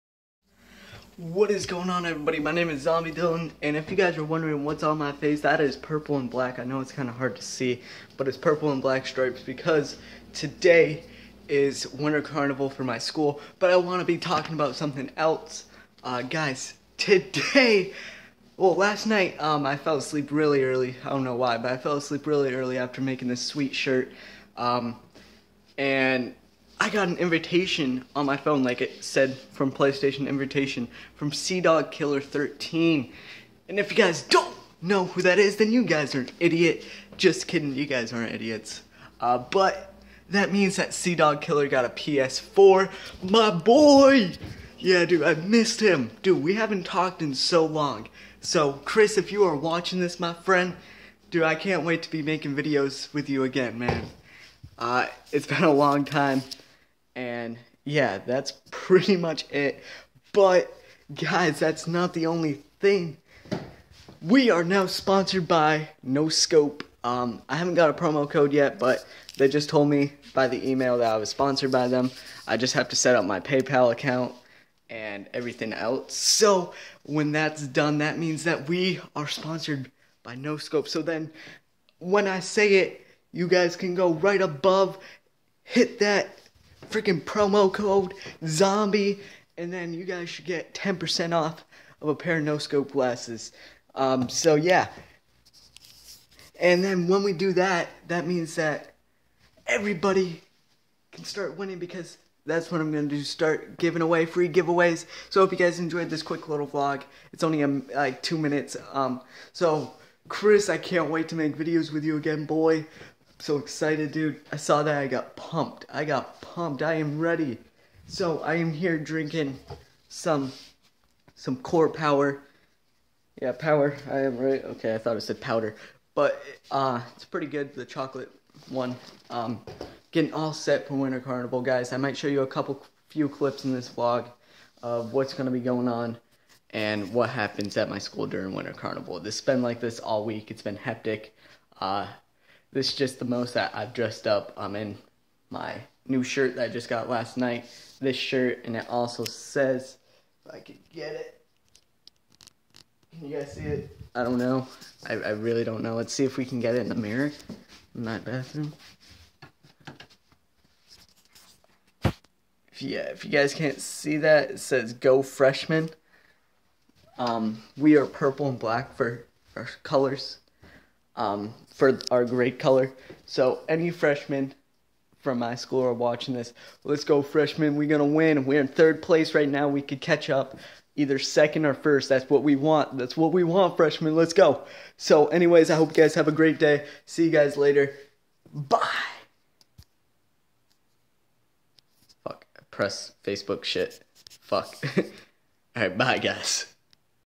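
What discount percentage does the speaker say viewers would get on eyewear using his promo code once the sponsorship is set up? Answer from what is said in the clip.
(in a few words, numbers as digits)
10%.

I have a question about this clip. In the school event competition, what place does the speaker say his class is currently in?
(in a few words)
Third place.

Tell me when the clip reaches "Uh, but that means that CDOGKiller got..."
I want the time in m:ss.
0:39.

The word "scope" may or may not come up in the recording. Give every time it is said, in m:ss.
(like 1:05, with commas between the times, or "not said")
1:06, 1:20, 1:32.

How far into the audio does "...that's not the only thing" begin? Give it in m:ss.
1:01.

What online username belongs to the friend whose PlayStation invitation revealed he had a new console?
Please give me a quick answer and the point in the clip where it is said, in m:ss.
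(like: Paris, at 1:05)
CDOGKiller 13, at 0:31.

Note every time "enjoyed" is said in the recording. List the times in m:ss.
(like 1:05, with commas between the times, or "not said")
1:45.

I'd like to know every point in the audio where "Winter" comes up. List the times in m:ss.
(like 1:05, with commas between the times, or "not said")
0:11, 2:10, 2:18.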